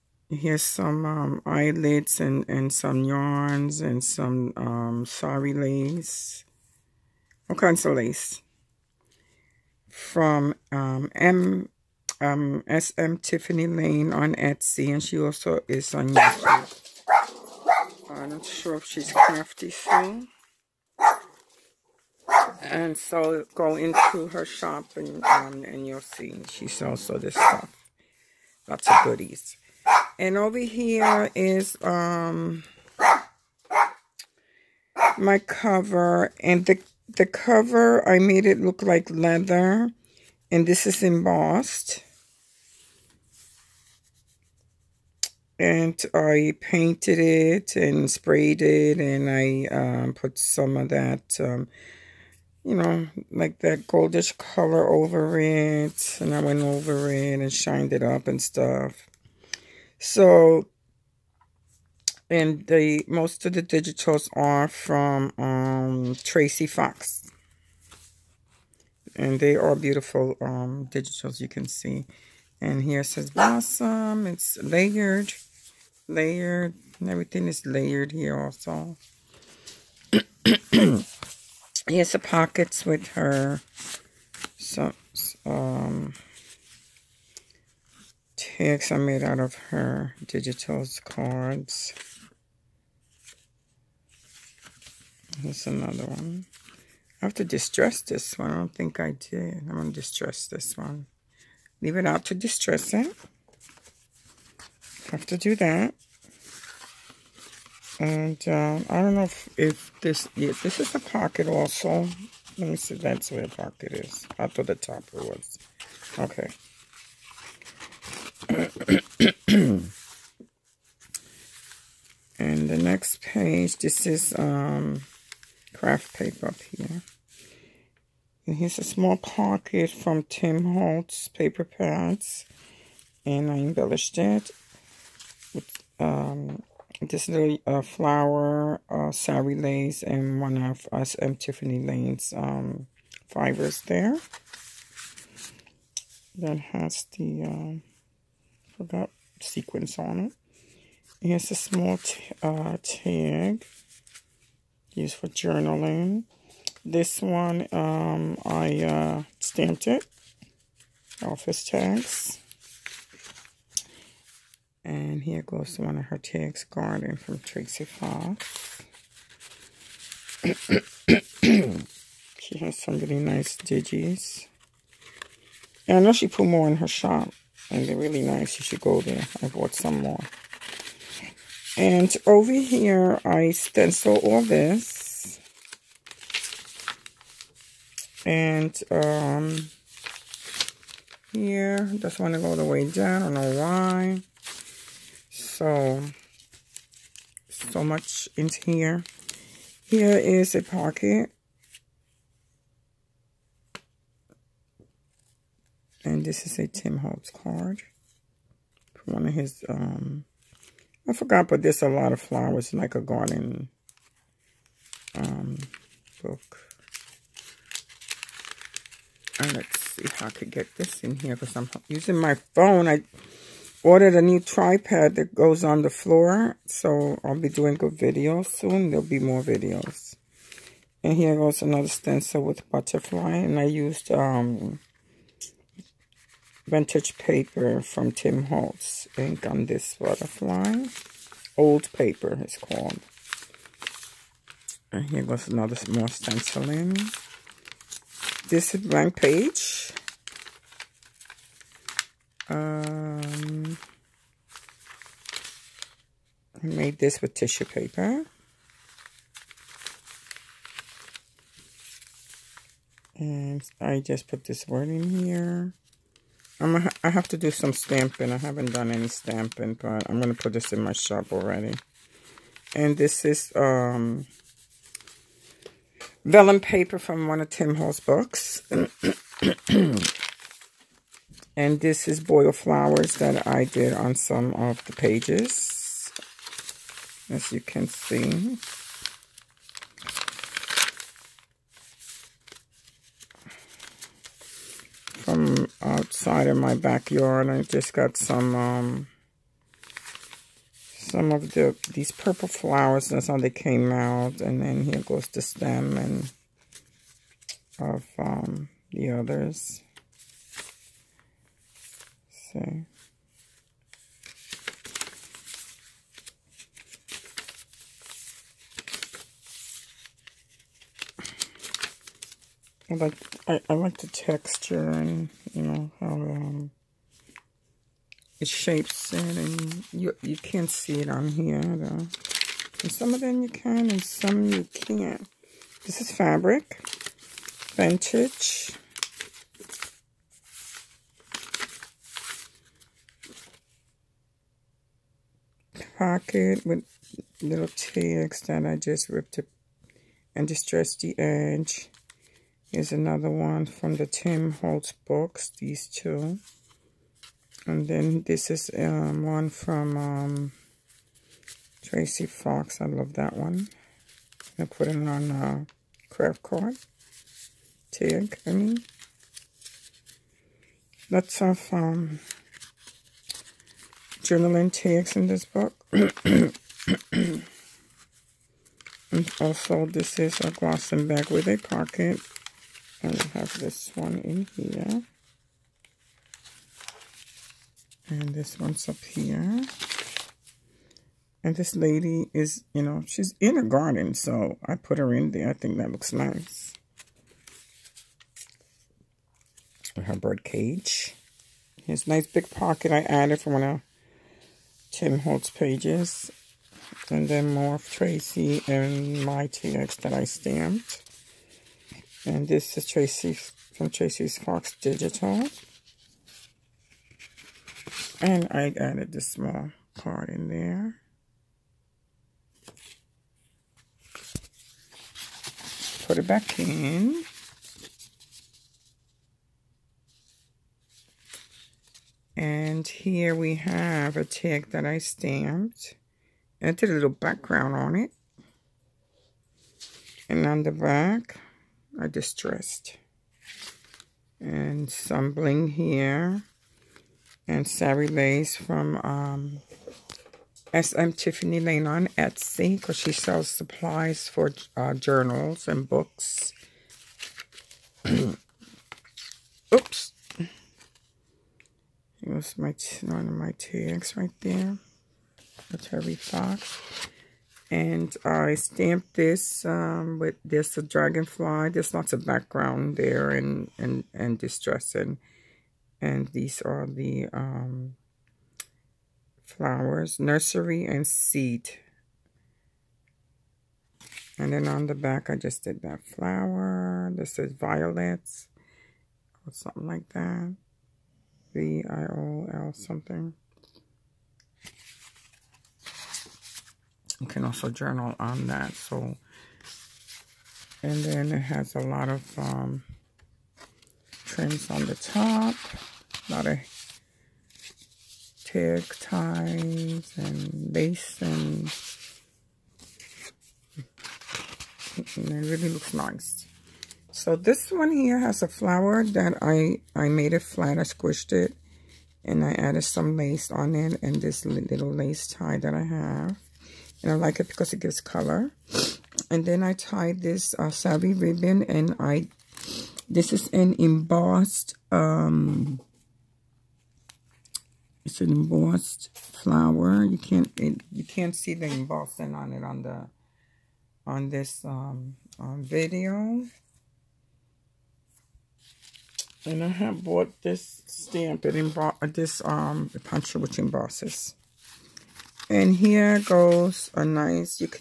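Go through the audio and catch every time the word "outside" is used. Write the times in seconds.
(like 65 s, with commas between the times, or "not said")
295 s.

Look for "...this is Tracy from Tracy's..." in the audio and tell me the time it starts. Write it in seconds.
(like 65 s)
412 s.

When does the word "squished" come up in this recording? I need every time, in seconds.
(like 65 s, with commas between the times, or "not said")
520 s.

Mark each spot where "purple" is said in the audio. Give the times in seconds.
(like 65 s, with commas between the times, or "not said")
302 s.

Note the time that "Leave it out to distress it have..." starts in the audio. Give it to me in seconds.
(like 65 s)
101 s.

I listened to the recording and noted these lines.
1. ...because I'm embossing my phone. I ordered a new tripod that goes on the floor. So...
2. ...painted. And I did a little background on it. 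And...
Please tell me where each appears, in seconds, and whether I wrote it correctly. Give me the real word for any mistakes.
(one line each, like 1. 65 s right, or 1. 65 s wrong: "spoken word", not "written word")
1. 221 s wrong: "using", not "embossing"
2. 434 s wrong: "stamped", not "painted".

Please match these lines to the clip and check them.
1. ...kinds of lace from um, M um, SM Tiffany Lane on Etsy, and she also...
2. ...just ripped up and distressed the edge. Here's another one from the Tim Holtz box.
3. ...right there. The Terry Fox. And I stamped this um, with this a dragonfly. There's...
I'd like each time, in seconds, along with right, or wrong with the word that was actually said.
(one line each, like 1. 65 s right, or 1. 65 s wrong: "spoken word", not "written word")
1. 7 s right
2. 348 s right
3. 464 s right.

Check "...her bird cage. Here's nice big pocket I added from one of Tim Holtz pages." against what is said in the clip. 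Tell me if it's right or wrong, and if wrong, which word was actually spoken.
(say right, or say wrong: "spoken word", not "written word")
right.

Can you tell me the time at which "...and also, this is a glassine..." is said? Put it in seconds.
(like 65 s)
379 s.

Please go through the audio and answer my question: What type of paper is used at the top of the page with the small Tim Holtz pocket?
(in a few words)
Craft paper.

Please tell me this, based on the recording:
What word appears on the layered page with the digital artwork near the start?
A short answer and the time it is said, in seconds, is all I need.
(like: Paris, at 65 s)
Blossom, at 73 s.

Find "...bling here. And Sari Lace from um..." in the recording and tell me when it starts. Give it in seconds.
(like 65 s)
445 s.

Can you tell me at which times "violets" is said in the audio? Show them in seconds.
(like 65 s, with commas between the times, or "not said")
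487 s.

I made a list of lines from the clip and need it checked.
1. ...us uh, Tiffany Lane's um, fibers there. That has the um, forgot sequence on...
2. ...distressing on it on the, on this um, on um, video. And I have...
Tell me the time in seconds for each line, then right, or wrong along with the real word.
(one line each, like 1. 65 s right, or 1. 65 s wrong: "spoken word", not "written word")
1. 140 s right
2. 541 s wrong: "embossing", not "distressing".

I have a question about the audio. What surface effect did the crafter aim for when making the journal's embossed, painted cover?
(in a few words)
Leather.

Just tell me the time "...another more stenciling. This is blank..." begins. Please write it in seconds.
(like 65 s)
245 s.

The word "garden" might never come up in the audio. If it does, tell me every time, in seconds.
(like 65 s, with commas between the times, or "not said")
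166 s, 213 s, 393 s.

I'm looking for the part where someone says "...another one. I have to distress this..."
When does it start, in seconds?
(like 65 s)
95 s.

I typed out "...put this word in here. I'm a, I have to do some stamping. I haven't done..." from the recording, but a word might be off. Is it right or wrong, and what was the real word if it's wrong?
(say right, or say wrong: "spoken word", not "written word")
right.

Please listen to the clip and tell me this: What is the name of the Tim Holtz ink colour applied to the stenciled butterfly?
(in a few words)
Old Paper.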